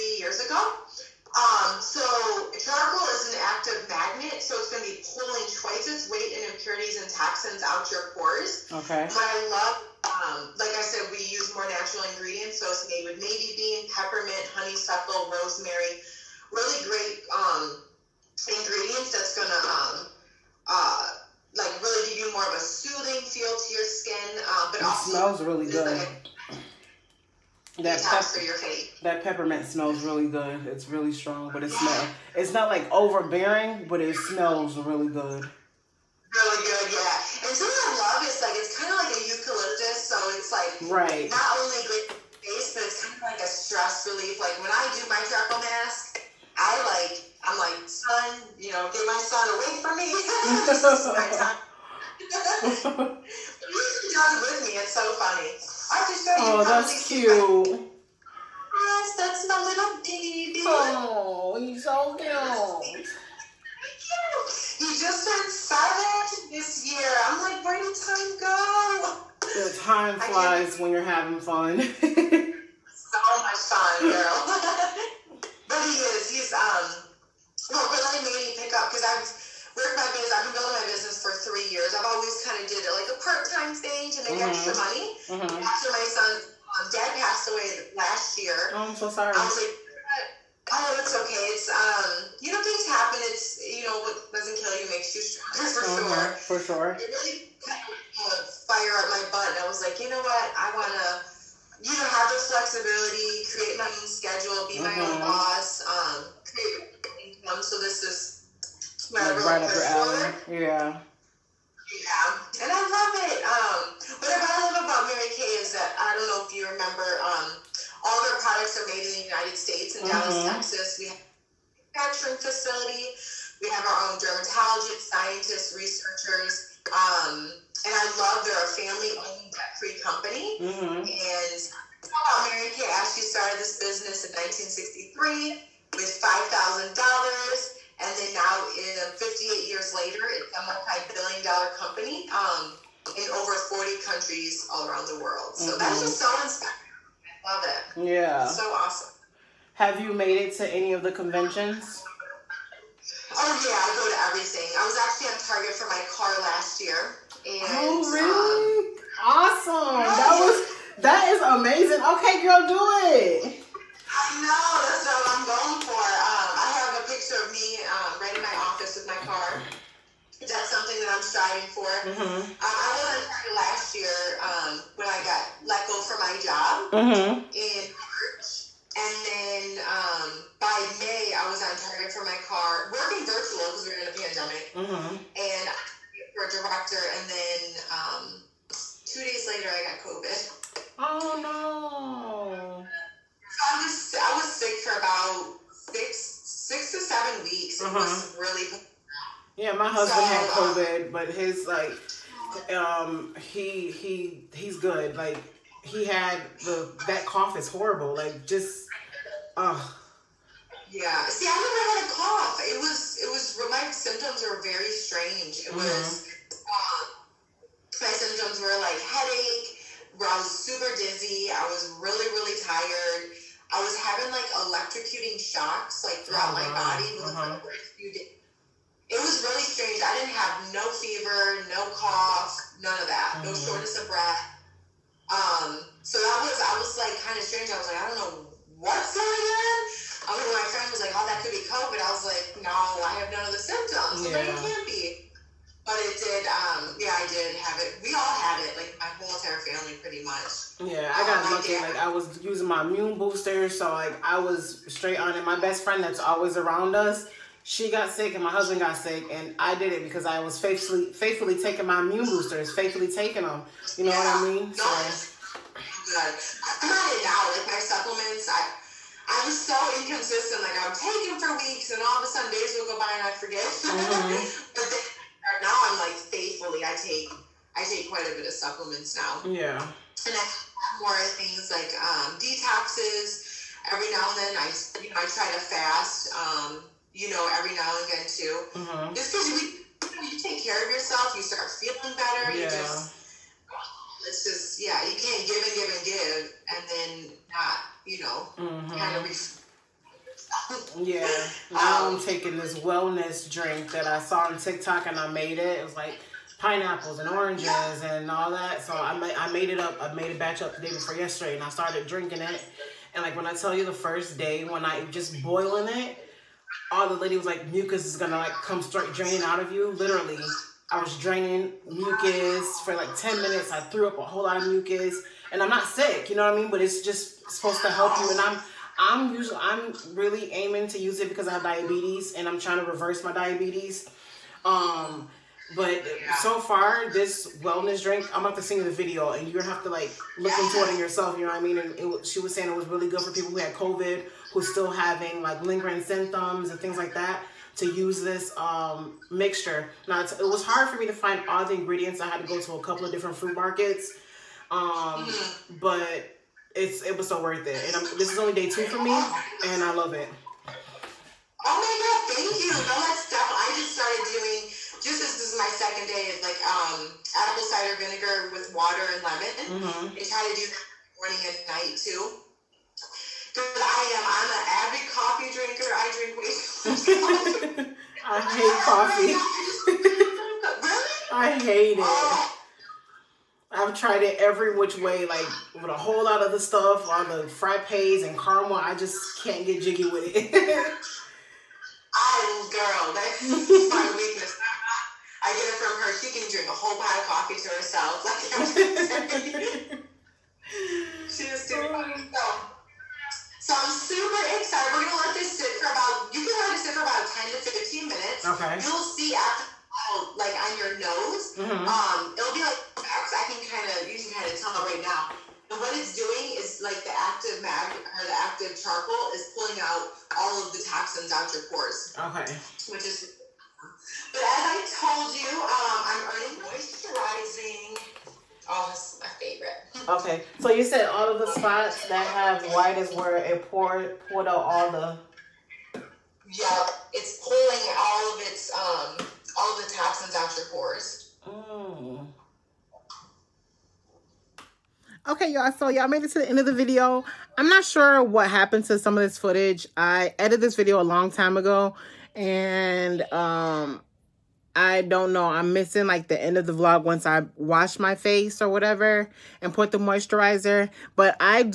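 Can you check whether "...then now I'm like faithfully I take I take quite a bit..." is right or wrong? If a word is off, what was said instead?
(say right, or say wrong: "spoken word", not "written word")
right.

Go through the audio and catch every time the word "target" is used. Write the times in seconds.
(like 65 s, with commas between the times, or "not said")
155 s, 181 s.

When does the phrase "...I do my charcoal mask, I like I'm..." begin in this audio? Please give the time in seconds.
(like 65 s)
44 s.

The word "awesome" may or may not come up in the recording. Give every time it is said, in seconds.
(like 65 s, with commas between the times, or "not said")
148 s, 159 s.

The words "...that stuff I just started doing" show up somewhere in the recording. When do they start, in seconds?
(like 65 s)
363 s.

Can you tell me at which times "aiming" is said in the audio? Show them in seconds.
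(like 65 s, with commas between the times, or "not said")
330 s.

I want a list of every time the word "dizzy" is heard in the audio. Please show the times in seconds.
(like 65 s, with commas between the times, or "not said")
220 s.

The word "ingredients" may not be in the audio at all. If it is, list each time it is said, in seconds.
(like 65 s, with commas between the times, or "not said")
12 s, 18 s, 351 s.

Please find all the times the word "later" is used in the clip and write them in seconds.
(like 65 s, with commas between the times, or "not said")
139 s, 189 s.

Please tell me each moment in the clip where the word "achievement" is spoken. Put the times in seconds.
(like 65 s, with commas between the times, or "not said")
not said.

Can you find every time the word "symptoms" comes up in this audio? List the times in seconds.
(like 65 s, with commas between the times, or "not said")
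213 s, 218 s, 243 s, 346 s.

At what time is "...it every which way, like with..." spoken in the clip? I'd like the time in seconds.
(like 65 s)
384 s.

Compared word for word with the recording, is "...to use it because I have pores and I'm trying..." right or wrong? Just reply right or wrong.
wrong.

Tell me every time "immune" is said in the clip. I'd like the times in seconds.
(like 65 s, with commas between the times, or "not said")
252 s, 262 s.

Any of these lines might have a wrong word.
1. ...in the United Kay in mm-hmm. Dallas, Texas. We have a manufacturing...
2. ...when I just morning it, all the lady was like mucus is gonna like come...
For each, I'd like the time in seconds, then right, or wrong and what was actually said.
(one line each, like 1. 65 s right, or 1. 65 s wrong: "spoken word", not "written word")
1. 119 s wrong: "States", not "Kay"
2. 314 s wrong: "boiling", not "morning".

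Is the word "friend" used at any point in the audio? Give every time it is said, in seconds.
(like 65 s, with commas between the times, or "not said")
240 s, 255 s.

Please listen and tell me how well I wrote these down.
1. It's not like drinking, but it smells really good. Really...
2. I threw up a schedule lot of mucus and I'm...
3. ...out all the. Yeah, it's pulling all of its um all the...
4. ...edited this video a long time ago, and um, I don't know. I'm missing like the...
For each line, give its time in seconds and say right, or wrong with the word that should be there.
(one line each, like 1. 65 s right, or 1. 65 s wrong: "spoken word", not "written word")
1. 32 s wrong: "overbearing", not "drinking"
2. 323 s wrong: "whole", not "schedule"
3. 434 s right
4. 450 s right.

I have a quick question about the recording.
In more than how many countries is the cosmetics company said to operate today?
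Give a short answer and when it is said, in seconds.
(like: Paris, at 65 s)
40, at 143 s.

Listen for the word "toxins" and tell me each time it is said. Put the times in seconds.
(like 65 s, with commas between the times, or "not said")
7 s, 420 s, 439 s.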